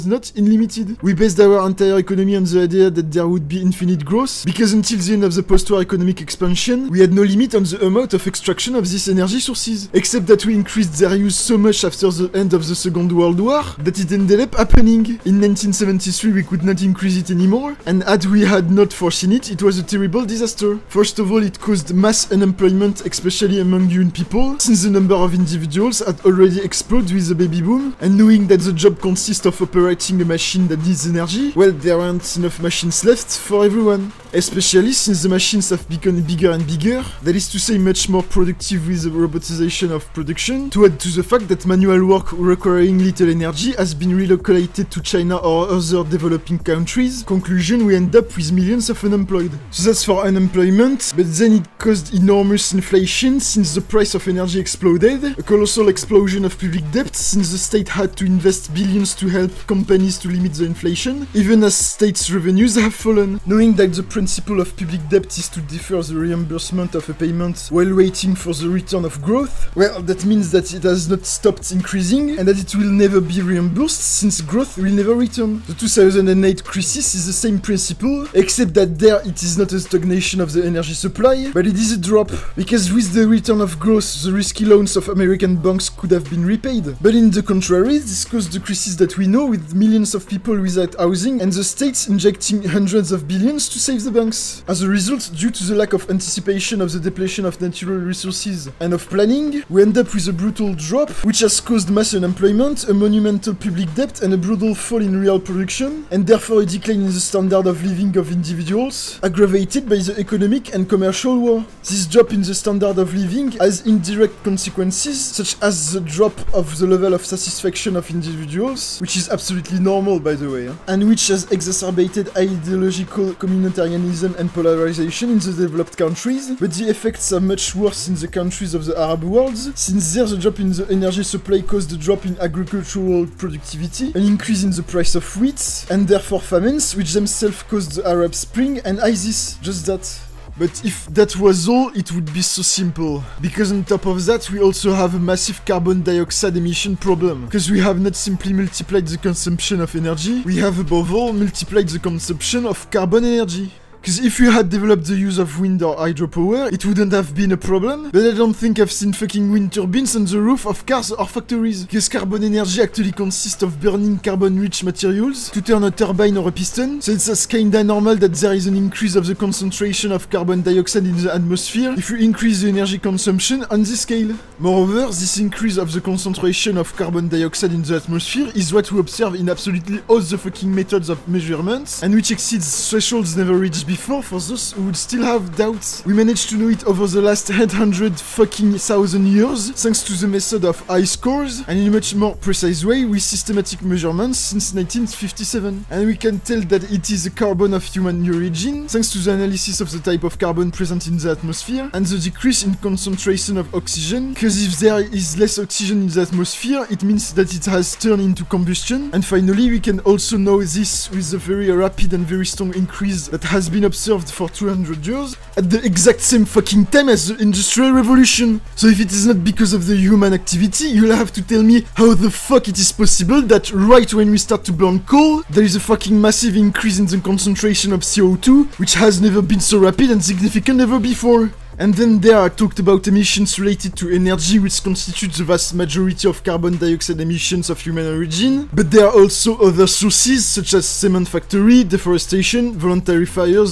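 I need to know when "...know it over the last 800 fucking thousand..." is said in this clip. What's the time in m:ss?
3:06.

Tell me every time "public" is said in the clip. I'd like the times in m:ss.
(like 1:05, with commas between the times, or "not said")
0:56, 1:04, 1:43.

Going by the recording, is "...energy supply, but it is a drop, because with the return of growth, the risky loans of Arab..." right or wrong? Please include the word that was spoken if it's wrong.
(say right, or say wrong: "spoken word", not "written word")
wrong: "American", not "Arab".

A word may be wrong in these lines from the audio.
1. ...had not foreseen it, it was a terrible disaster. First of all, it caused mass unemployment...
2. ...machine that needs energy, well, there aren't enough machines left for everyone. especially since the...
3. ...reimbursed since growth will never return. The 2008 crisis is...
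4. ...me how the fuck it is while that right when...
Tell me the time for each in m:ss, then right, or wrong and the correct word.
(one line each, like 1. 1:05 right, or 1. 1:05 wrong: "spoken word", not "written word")
1. 0:18 right
2. 0:30 right
3. 1:13 right
4. 3:41 wrong: "possible", not "while".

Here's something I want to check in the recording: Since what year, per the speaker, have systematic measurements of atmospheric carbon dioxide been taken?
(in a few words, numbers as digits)
1957.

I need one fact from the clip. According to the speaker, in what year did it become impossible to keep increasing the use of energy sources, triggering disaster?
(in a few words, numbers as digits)
1973.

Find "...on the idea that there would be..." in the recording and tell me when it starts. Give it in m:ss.
0:02.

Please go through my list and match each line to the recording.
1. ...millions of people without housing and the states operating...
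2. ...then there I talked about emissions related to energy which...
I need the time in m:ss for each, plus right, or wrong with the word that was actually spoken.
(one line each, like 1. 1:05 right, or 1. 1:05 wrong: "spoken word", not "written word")
1. 1:29 wrong: "injecting", not "operating"
2. 3:51 right.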